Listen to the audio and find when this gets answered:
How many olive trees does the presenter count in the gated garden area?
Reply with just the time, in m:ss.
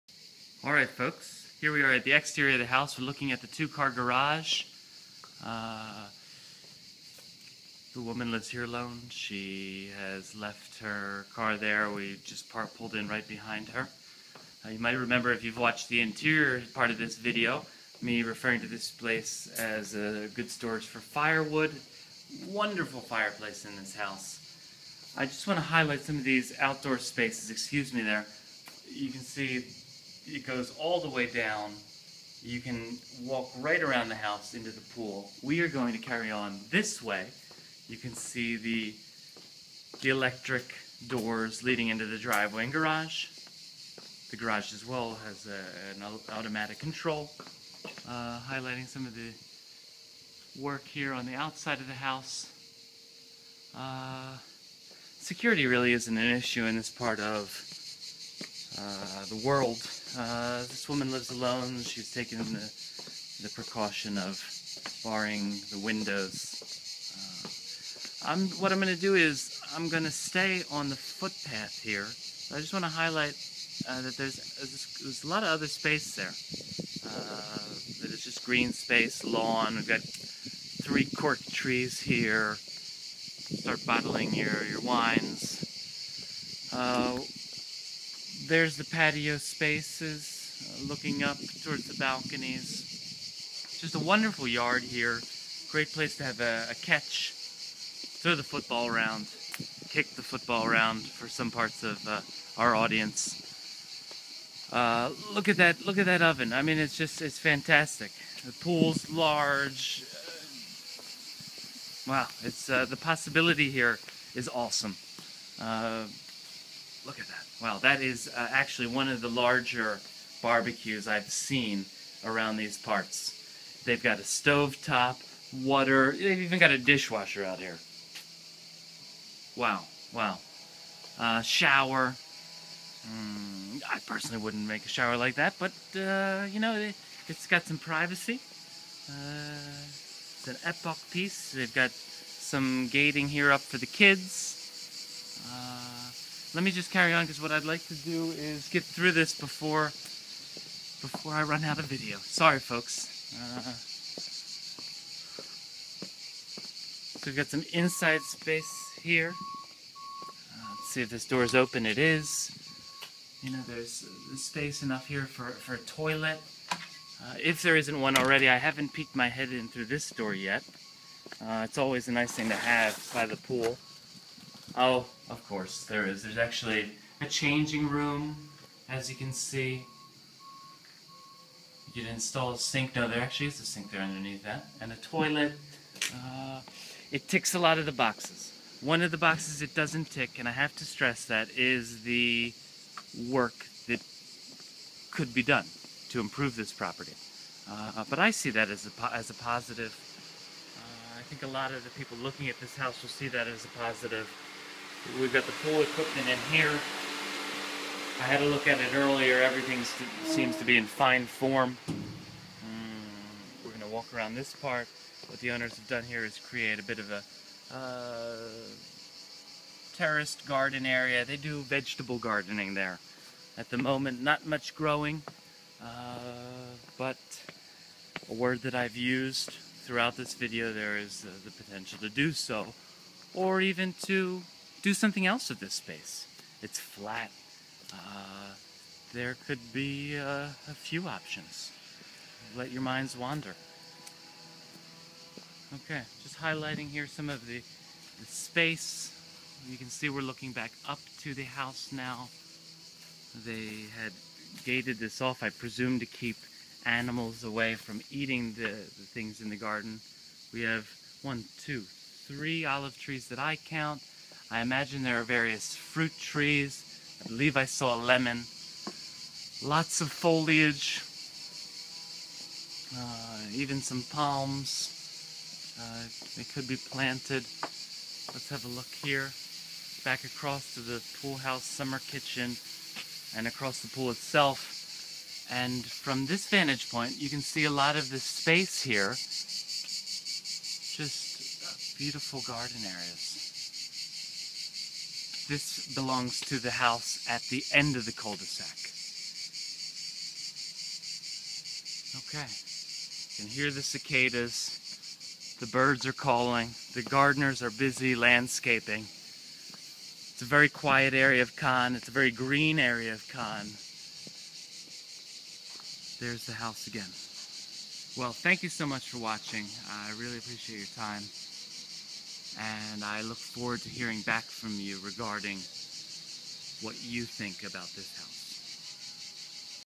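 4:21.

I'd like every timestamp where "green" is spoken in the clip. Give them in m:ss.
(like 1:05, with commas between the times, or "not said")
1:18, 5:12.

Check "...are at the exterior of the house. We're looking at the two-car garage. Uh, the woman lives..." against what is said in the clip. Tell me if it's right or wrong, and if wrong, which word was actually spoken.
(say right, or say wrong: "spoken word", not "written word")
right.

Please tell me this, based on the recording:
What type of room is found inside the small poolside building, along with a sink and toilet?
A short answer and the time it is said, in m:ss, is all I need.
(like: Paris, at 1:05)
Changing room, at 2:57.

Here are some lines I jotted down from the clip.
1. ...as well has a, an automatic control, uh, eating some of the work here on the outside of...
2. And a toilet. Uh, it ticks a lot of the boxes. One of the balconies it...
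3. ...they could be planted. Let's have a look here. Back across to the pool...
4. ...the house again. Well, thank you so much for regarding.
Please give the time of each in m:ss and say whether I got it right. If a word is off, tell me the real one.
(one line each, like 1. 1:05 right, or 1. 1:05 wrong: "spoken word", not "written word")
1. 0:44 wrong: "highlighting", not "eating"
2. 3:04 wrong: "boxes", not "balconies"
3. 4:36 right
4. 5:16 wrong: "watching", not "regarding".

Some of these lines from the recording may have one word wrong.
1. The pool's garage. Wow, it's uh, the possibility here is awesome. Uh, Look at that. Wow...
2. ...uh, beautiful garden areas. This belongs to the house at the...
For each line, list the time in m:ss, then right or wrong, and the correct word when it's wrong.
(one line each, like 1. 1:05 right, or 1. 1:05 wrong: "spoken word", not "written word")
1. 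1:48 wrong: "large", not "garage"
2. 4:51 right.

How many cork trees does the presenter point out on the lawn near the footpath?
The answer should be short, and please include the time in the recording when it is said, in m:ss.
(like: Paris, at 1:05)
3, at 1:20.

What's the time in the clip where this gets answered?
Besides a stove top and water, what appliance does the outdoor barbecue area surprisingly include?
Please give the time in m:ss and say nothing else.
2:06.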